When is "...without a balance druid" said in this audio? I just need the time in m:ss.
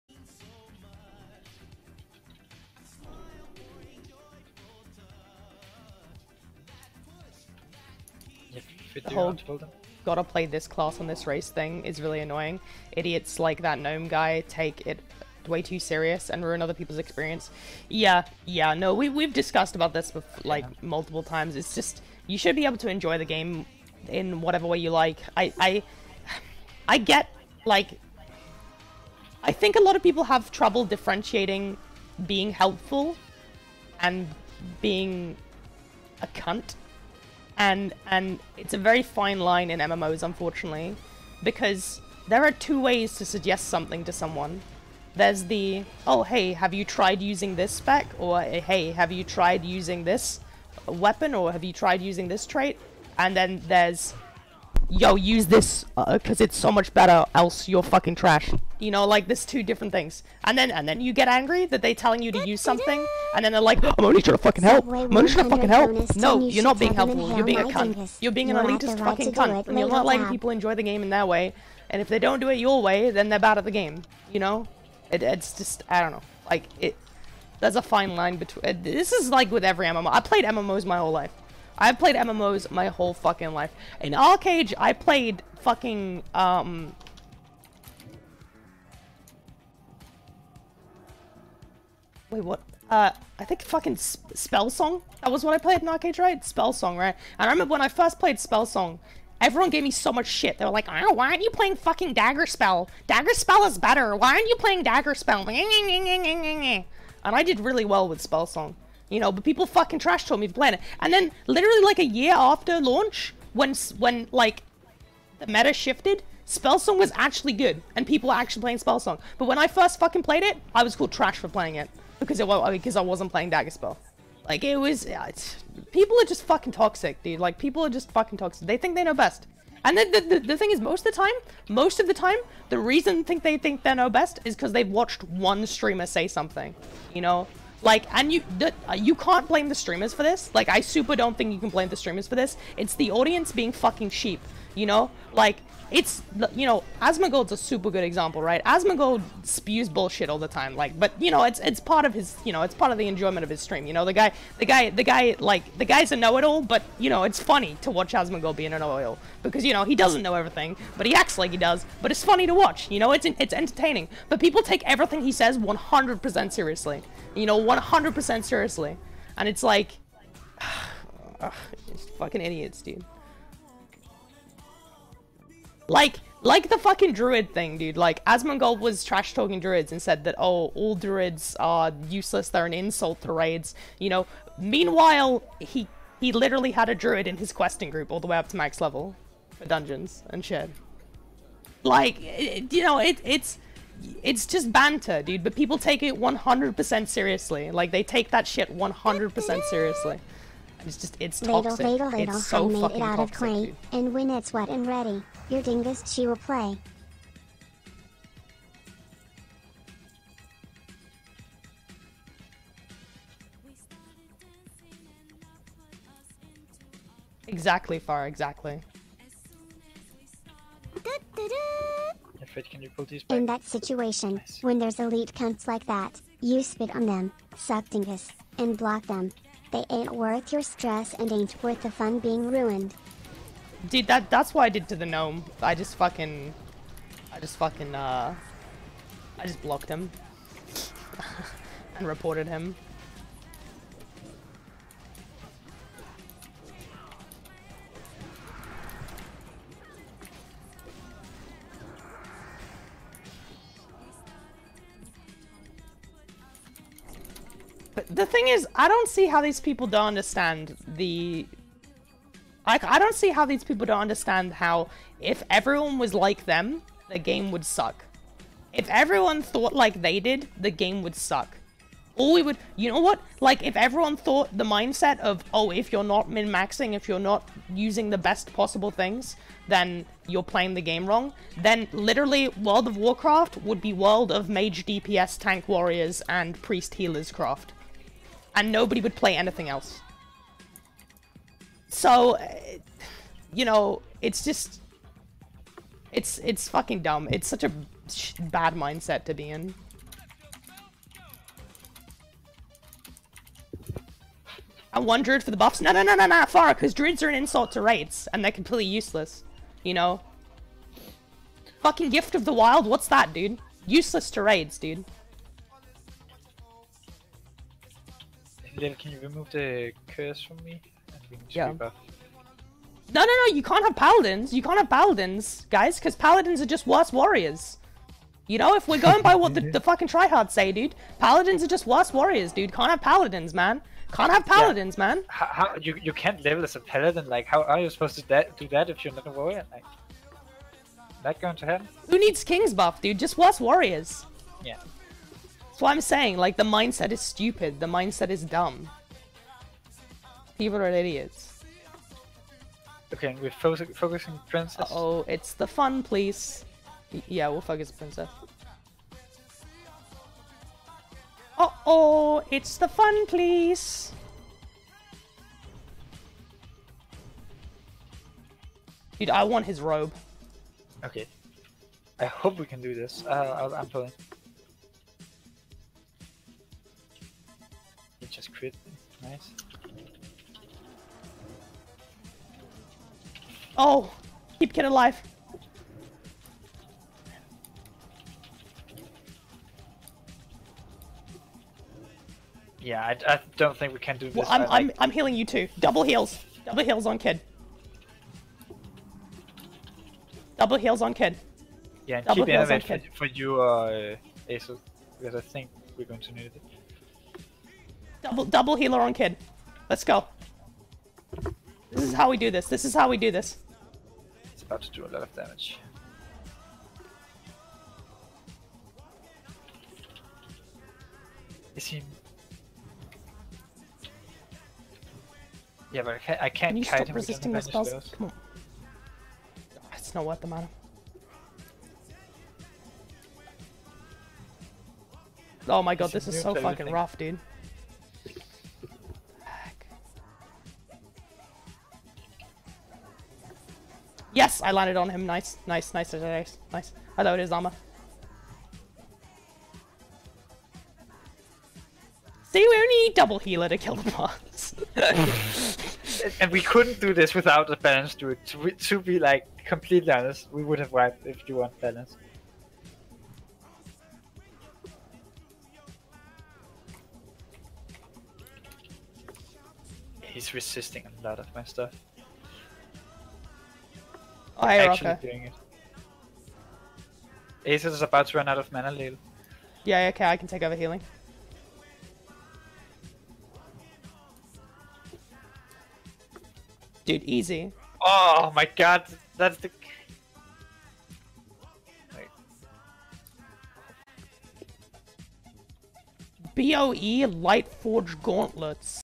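7:37.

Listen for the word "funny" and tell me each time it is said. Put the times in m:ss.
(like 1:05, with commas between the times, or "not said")
2:37, 2:42.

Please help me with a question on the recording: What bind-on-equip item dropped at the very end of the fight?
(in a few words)
Light Forge Gauntlets.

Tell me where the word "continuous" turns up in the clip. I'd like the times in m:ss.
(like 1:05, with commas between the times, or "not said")
not said.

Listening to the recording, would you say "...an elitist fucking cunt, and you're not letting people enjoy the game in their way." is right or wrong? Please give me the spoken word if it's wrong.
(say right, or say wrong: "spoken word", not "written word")
right.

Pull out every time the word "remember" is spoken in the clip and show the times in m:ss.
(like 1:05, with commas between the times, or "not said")
1:37.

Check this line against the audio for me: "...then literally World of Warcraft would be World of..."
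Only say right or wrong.
right.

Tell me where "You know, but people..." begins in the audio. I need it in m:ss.
1:49.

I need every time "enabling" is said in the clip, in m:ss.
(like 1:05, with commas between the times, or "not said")
not said.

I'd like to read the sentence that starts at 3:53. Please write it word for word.
Dude, that that's what I did to the gnome.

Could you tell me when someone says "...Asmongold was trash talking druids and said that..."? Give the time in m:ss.
2:58.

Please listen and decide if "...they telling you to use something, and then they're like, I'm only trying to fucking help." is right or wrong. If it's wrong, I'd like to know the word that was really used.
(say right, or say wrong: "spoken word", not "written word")
right.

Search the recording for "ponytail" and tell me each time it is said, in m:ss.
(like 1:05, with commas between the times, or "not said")
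not said.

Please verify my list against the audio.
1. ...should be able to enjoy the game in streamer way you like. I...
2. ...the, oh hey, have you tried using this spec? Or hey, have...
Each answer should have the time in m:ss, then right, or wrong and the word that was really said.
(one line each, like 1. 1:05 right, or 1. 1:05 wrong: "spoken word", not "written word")
1. 0:22 wrong: "whatever", not "streamer"
2. 0:45 right.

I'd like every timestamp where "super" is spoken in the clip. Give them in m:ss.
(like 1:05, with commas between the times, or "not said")
2:20, 2:27.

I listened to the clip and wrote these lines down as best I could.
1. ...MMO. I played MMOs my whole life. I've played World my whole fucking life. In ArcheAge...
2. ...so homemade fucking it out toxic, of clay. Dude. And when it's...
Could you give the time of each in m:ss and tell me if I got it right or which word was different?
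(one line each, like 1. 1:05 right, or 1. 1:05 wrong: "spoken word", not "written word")
1. 1:19 wrong: "MMOs", not "World"
2. 3:22 right.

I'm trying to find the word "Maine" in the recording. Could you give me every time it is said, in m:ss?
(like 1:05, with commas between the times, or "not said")
not said.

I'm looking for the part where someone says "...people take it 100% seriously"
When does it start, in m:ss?
3:15.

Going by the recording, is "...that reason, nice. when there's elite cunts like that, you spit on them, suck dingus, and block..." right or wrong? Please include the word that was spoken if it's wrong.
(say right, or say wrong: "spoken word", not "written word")
wrong: "situation", not "reason".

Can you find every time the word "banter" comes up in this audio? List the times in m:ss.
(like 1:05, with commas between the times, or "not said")
3:14.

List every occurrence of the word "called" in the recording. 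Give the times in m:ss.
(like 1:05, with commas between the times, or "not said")
2:00.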